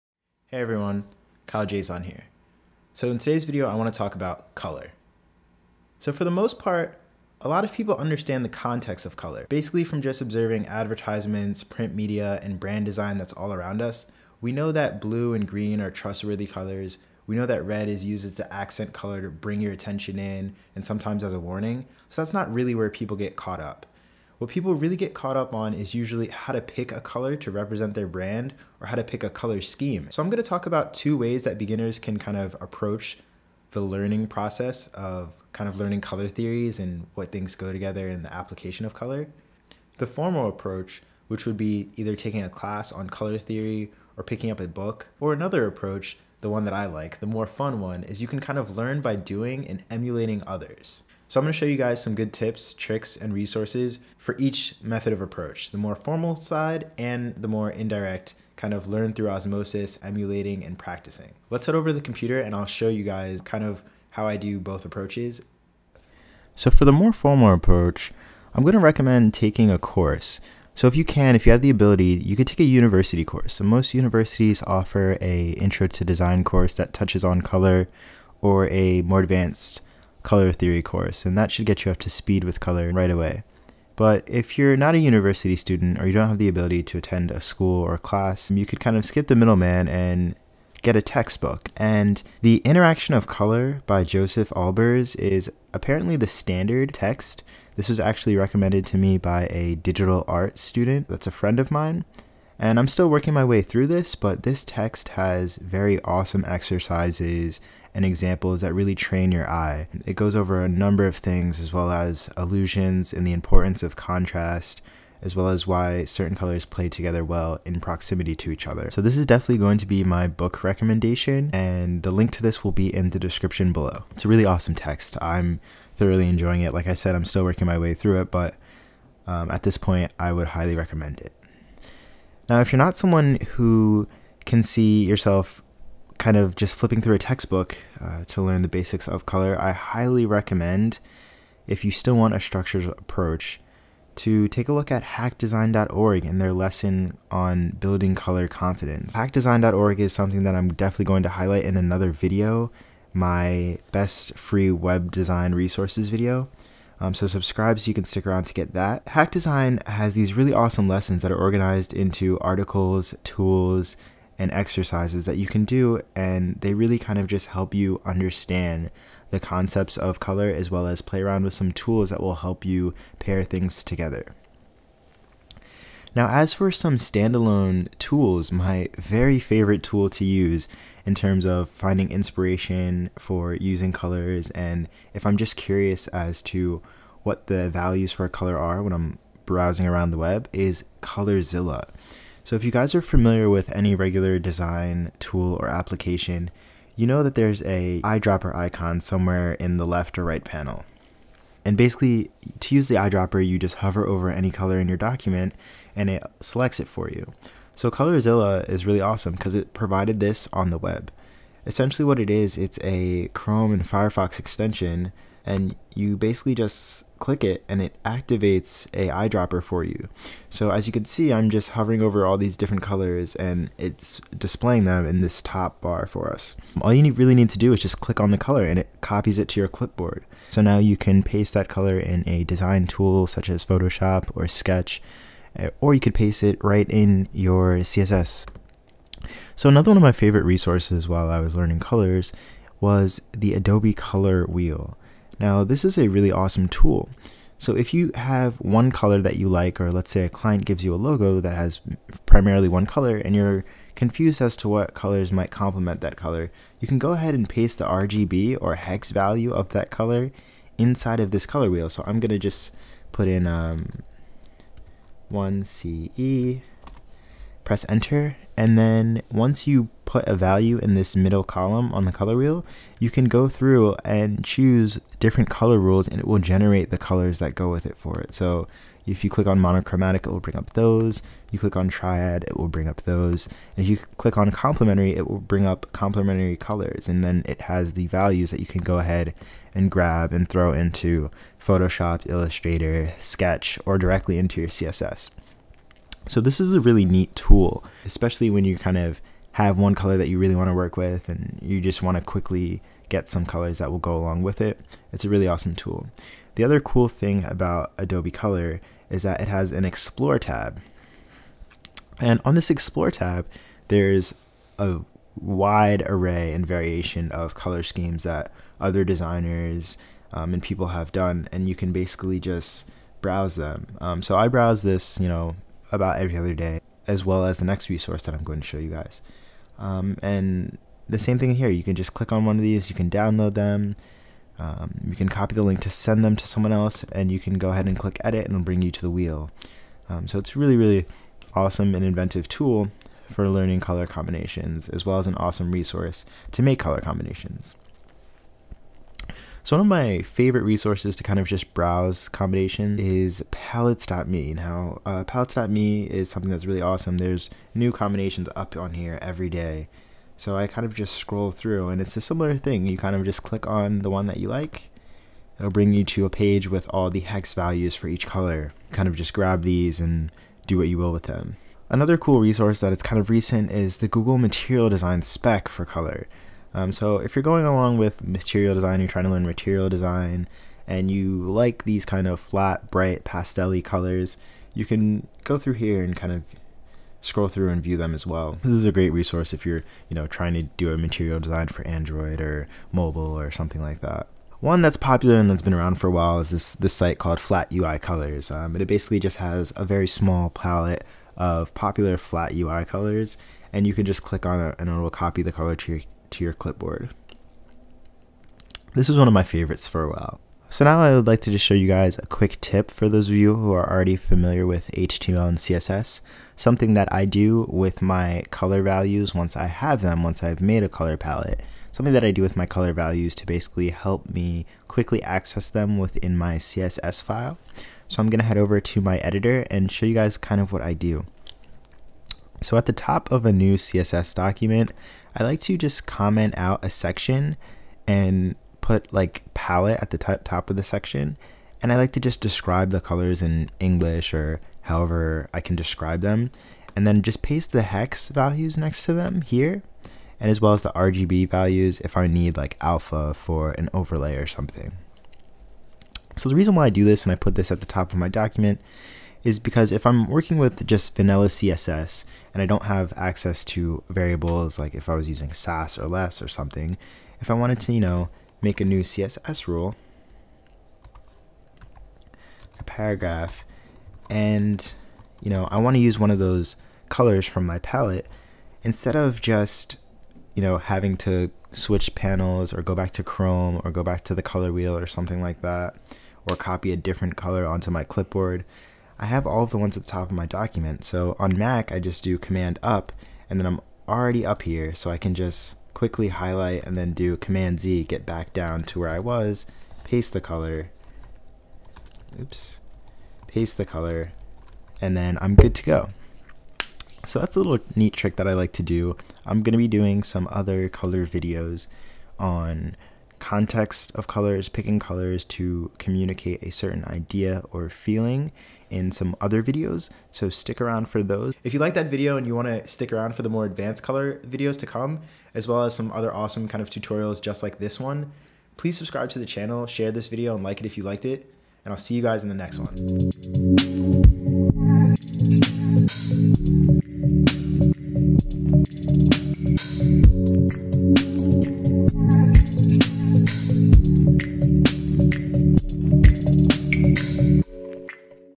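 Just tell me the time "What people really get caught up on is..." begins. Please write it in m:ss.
0:24.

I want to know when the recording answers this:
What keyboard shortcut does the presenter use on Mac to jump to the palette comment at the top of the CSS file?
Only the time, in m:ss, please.
8:12.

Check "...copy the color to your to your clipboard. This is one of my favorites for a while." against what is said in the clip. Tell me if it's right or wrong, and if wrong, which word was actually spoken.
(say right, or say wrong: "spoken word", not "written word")
right.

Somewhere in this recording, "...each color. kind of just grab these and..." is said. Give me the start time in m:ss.
6:08.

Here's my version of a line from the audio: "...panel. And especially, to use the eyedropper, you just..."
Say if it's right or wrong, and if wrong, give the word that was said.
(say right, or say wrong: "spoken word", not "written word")
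wrong: "basically", not "especially".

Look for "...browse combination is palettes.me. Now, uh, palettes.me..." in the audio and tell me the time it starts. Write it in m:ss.
5:51.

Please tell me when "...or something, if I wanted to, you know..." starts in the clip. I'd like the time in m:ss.
7:46.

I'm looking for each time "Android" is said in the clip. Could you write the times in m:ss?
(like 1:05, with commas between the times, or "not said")
6:31.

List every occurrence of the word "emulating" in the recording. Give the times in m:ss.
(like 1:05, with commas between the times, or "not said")
0:49, 1:00.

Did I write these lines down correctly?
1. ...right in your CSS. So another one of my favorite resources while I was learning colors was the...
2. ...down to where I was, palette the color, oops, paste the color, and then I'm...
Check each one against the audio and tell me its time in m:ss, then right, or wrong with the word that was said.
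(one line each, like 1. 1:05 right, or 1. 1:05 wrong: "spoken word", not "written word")
1. 3:56 right
2. 8:18 wrong: "paste", not "palette".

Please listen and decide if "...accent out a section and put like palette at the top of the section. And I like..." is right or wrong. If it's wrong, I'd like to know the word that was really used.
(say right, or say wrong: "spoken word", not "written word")
wrong: "comment", not "accent".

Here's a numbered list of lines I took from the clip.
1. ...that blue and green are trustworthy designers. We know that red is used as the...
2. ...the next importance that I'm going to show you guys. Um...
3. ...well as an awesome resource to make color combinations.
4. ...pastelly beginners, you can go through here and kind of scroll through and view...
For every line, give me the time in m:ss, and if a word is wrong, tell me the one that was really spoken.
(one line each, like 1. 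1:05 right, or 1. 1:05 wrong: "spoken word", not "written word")
1. 0:14 wrong: "colors", not "designers"
2. 5:27 wrong: "resource", not "importance"
3. 5:45 right
4. 6:23 wrong: "colors", not "beginners".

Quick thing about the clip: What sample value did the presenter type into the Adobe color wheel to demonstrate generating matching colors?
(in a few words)
1CE.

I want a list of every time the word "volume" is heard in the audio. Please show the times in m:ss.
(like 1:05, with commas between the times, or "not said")
not said.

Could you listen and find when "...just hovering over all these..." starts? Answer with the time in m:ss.
3:41.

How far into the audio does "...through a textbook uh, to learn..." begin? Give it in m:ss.
2:17.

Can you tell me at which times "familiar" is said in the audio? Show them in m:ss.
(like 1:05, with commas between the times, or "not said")
3:13, 6:54.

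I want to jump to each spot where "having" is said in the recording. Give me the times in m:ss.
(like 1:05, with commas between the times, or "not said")
8:00.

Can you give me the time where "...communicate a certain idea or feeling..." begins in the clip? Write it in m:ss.
8:35.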